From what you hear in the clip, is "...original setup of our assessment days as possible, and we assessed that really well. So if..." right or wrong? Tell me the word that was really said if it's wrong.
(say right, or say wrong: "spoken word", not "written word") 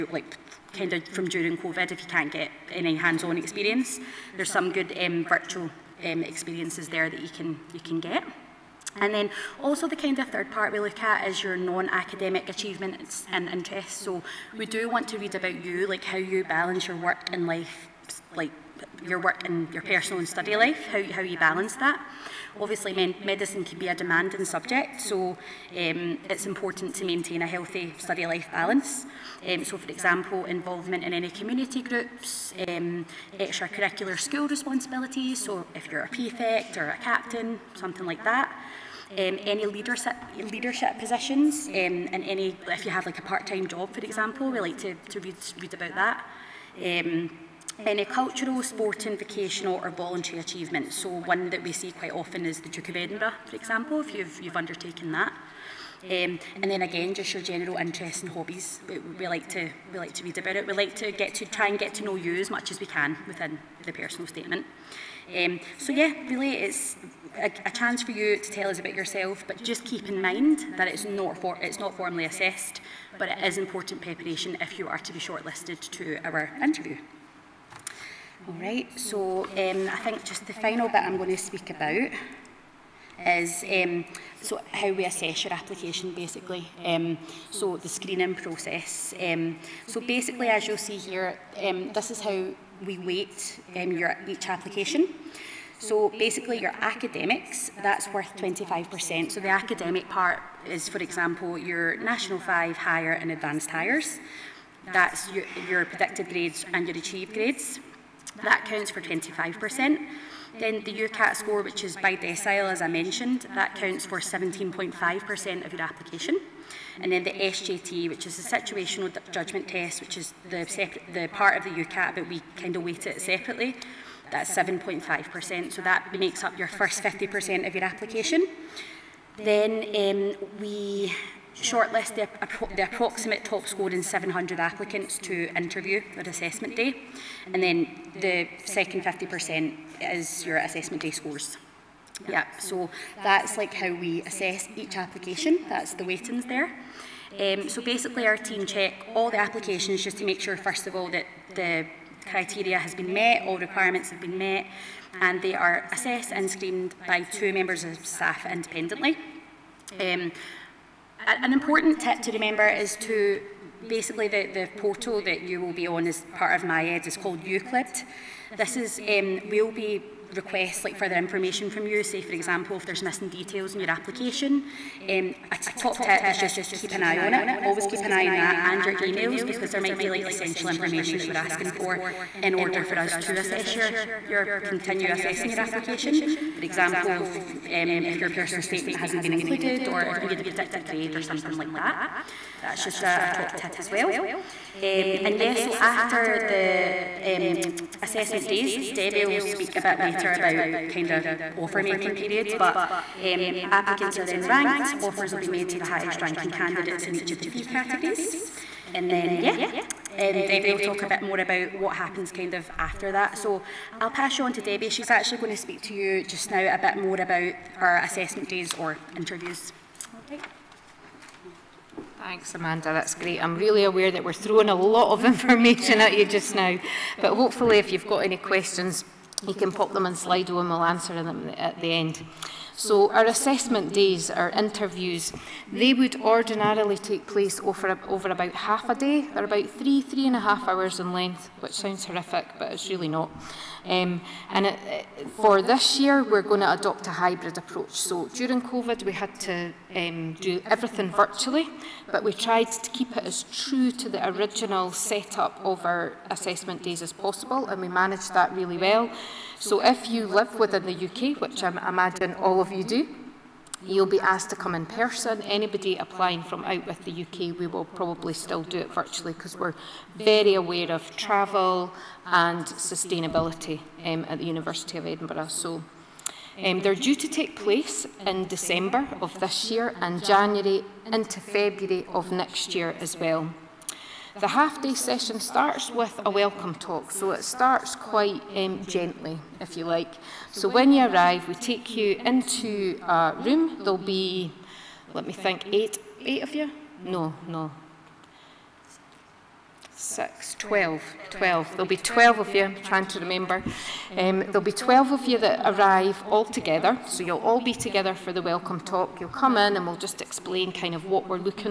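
wrong: "managed", not "assessed".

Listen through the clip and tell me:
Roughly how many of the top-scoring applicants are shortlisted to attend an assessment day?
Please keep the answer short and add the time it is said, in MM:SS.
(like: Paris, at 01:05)
700, at 02:14.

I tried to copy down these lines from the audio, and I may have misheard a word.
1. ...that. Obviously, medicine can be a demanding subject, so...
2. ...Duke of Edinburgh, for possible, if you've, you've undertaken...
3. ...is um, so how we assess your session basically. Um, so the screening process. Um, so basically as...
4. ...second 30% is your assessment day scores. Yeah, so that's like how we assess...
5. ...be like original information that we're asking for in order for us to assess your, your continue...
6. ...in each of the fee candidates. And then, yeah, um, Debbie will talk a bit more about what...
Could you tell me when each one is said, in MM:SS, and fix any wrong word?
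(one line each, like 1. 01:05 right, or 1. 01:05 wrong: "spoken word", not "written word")
1. 00:21 right
2. 00:52 wrong: "example", not "possible"
3. 01:23 wrong: "application", not "session"
4. 02:18 wrong: "50", not "30"
5. 02:59 wrong: "essential", not "original"
6. 03:27 wrong: "categories", not "candidates".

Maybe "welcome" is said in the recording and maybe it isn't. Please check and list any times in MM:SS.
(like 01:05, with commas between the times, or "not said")
04:46, 05:08.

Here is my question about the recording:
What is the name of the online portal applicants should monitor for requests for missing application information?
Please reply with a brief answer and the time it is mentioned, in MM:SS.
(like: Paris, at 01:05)
Euclid, at 02:47.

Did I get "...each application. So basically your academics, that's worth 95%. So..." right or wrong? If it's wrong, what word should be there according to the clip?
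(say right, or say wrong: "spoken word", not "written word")
wrong: "25", not "95".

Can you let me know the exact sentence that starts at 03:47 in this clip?
But hopefully, if you've got any questions, you can pop them in Slido and we'll answer them at the end.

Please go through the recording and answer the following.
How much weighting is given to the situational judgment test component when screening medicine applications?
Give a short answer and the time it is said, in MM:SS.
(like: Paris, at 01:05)
7.5%, at 02:04.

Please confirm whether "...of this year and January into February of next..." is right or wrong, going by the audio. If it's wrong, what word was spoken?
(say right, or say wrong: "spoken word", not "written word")
right.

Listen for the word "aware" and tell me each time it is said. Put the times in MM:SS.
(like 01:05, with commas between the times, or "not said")
03:43, 04:30.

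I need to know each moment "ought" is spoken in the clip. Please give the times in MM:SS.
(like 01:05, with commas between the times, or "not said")
not said.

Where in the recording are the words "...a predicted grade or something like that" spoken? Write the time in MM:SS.
03:10.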